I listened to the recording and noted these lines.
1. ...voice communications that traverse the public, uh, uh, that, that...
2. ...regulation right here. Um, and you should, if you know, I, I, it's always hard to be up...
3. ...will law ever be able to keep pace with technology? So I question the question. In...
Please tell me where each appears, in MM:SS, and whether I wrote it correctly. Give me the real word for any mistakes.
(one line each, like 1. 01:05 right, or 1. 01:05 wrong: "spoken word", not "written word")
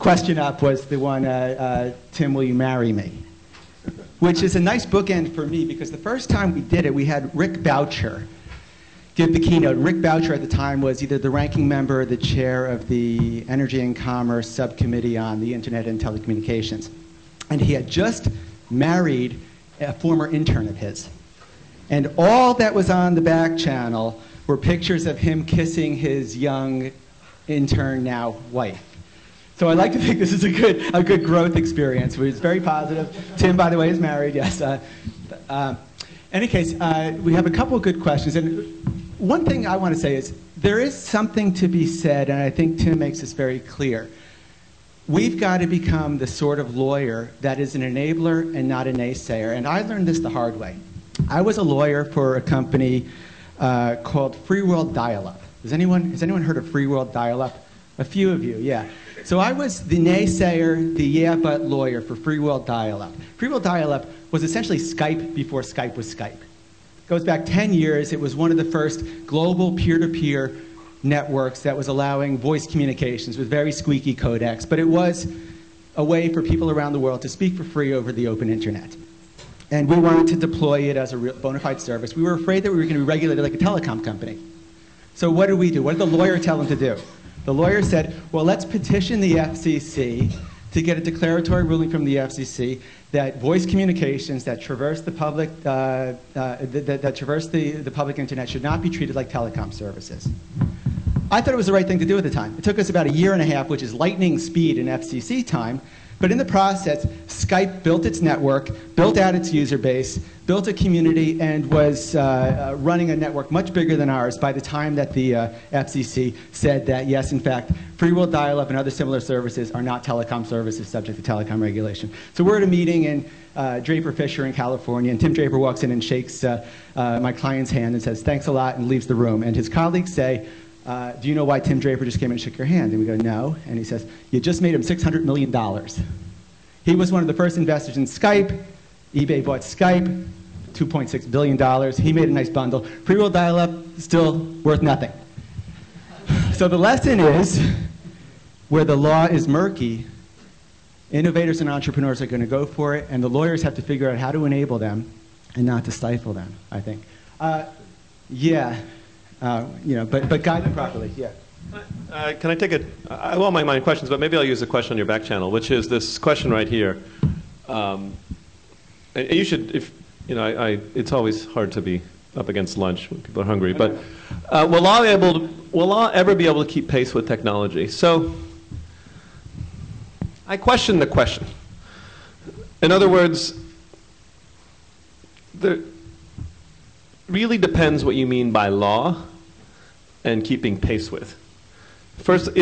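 1. 01:33 right
2. 02:46 wrong: "question", not "regulation"
3. 02:55 right.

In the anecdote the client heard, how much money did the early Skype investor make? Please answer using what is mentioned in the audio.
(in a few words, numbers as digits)
$600 million.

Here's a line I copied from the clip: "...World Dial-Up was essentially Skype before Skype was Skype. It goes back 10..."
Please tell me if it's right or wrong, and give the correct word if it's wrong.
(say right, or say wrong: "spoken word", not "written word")
right.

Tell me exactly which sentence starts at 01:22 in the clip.
We were afraid that we were going to be regulated like a telecom company.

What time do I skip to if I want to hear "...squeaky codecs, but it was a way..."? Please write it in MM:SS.
01:13.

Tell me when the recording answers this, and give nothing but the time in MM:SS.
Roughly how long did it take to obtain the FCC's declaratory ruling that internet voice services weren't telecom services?
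01:43.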